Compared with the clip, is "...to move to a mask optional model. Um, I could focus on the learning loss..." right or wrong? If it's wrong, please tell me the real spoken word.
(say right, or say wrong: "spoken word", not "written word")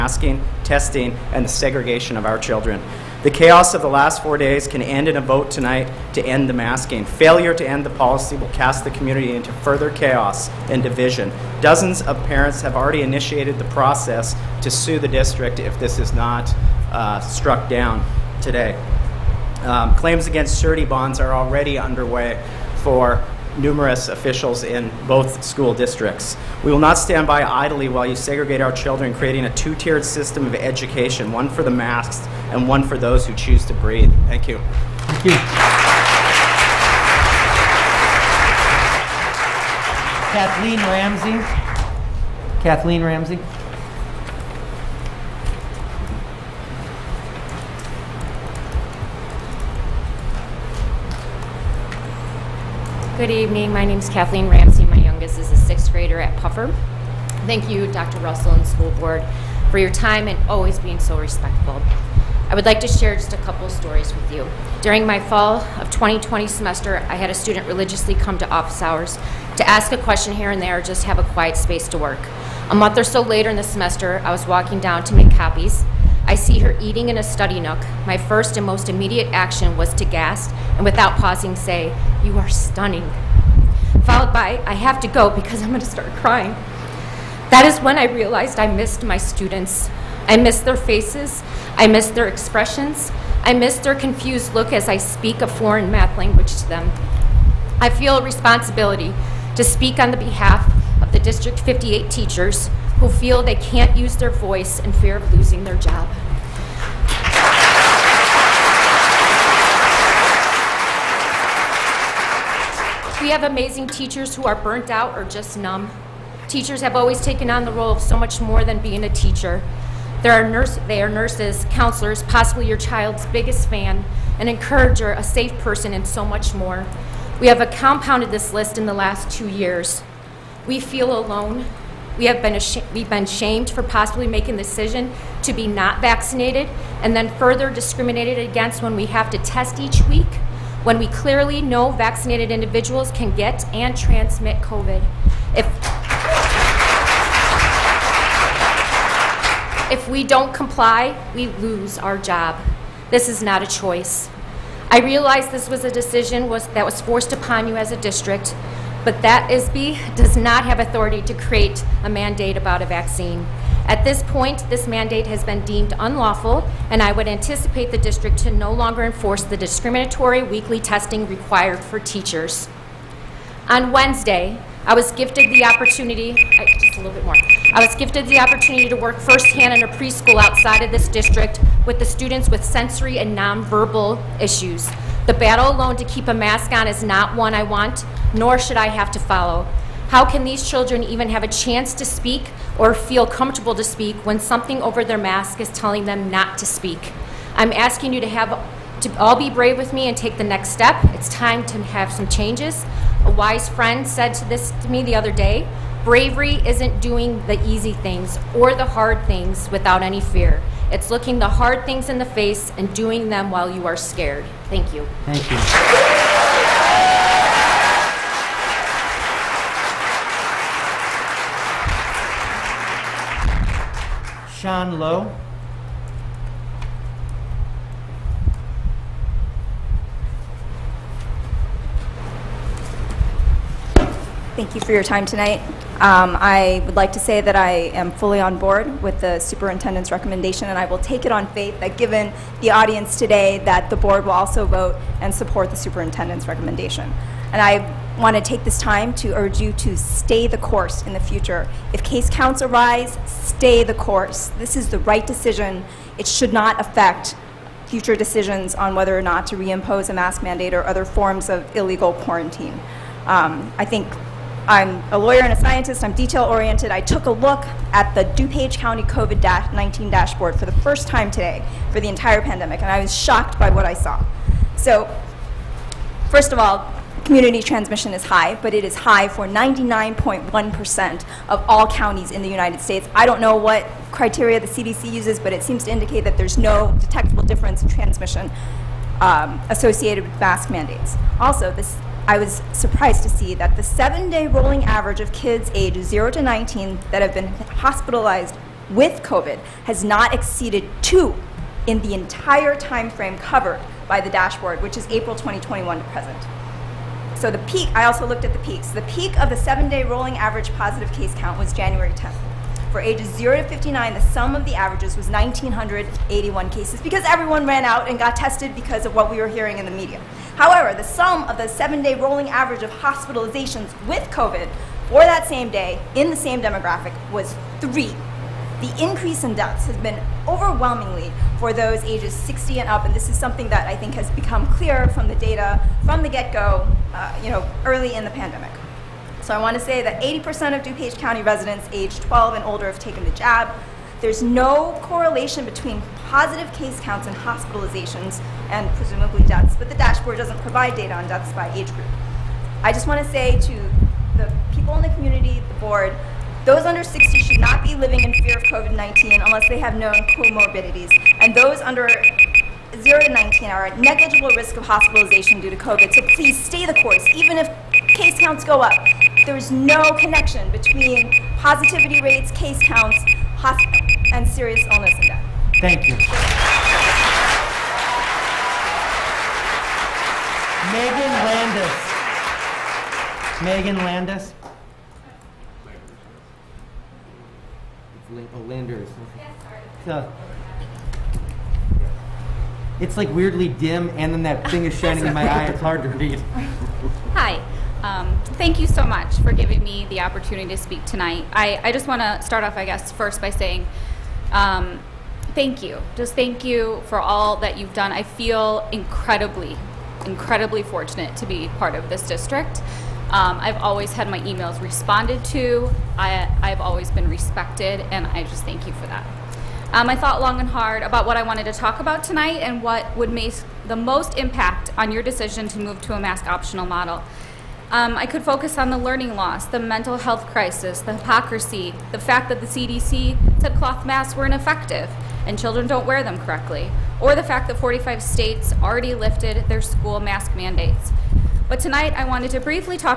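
right.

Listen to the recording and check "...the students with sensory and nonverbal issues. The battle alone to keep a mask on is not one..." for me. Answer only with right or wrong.
right.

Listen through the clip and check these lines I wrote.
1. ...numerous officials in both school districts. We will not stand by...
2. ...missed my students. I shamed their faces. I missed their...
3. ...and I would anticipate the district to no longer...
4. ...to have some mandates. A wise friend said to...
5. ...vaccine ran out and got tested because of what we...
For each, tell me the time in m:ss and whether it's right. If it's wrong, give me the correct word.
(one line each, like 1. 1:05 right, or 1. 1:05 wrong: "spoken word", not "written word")
1. 0:23 right
2. 1:28 wrong: "missed", not "shamed"
3. 2:46 right
4. 3:21 wrong: "changes", not "mandates"
5. 5:17 wrong: "everyone", not "vaccine".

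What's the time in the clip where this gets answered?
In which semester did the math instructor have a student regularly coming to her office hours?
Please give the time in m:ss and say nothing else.
1:05.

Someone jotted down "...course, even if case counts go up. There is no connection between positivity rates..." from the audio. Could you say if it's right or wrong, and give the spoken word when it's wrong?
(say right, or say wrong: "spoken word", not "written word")
right.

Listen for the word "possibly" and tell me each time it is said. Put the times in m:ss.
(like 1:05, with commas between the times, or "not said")
2:02, 2:13.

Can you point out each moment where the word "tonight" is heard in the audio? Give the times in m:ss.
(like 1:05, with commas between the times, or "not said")
0:05, 3:55, 6:41, 7:02, 7:21.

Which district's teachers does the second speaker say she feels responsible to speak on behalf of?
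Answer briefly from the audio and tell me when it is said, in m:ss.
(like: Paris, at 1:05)
District 58, at 1:41.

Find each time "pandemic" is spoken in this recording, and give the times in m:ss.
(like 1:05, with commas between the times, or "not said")
4:32, 5:38.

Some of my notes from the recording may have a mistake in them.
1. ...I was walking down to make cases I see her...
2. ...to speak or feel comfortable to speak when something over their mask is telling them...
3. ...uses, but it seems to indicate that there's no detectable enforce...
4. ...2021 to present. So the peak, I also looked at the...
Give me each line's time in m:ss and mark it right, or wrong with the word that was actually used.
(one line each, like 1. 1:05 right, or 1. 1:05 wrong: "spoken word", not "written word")
1. 1:14 wrong: "copies", not "cases"
2. 3:11 right
3. 4:45 wrong: "difference", not "enforce"
4. 5:05 right.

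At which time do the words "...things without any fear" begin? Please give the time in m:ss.
3:29.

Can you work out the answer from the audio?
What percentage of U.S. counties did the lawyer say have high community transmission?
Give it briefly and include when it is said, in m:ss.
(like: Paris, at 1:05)
99.1%, at 4:39.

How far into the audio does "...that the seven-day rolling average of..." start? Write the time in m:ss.
4:53.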